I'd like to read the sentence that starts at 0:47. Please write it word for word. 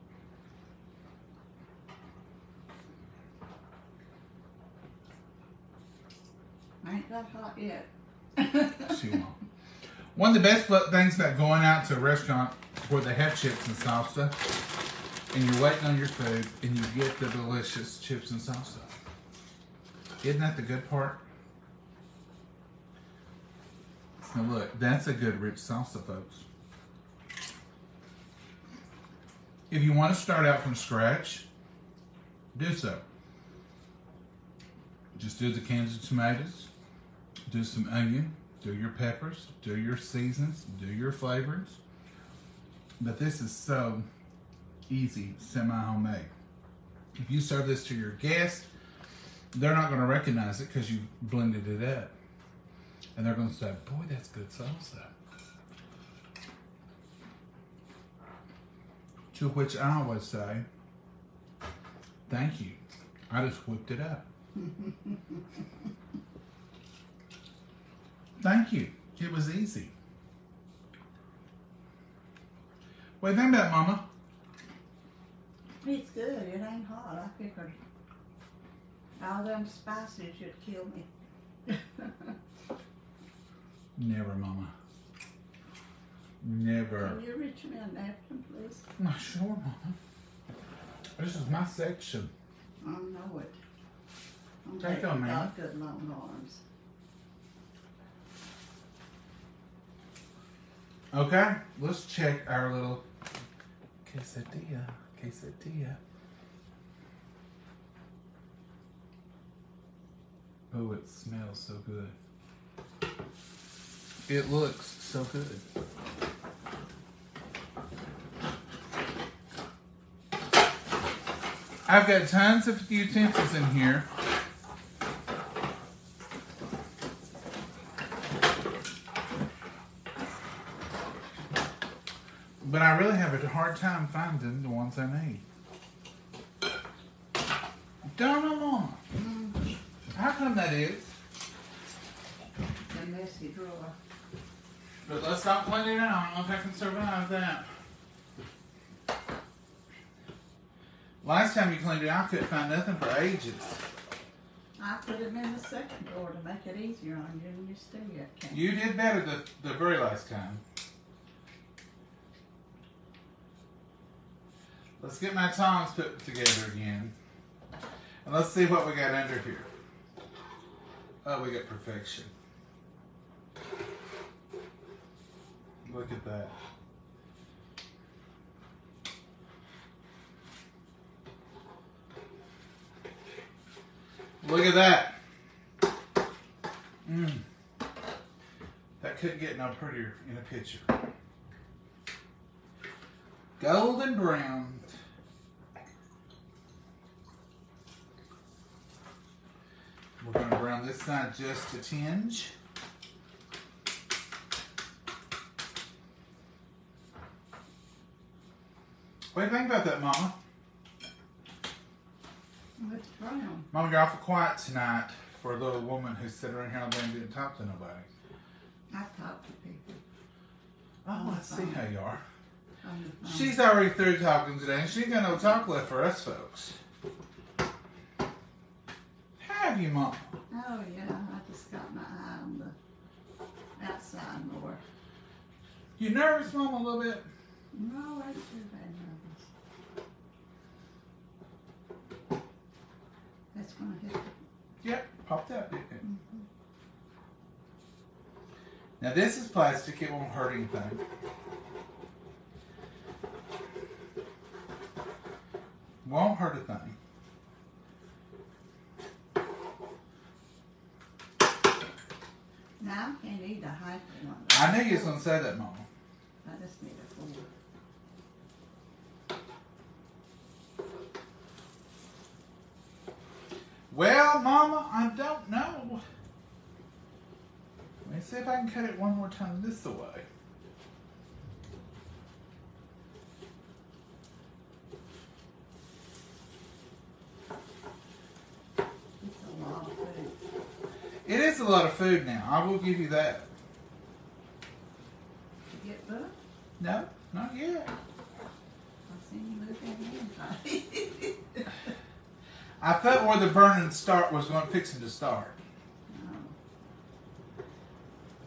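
If you serve this to your guests, they're not going to recognize it because you blended it up.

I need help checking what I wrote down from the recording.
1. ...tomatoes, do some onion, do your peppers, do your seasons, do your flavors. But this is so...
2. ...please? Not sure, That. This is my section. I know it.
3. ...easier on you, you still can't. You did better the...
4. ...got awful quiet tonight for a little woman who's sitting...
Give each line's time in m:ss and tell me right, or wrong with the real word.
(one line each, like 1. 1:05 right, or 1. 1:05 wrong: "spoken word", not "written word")
1. 0:36 right
2. 1:28 wrong: "Mama", not "That"
3. 2:36 right
4. 3:33 right.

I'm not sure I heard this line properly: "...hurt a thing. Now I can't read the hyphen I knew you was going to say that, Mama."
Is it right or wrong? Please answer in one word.
right.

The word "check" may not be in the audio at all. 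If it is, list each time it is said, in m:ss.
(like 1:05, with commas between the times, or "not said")
1:42.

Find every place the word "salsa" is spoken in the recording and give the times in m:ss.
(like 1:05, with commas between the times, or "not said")
0:13, 0:18, 0:25, 0:54.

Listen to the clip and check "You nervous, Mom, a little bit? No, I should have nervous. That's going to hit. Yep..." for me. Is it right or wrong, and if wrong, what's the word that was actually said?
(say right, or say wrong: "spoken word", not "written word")
right.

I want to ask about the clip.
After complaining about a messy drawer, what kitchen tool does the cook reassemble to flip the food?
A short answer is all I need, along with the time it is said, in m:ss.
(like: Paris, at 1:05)
tongs, at 2:45.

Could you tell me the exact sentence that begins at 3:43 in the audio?
She's already through talking today, and she ain't got no talk left for us folks have you, Mom?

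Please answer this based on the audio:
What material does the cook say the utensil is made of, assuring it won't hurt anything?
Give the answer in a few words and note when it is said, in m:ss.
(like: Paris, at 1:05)
plastic, at 4:09.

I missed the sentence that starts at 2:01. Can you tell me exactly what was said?
I've got tons of utensils in here.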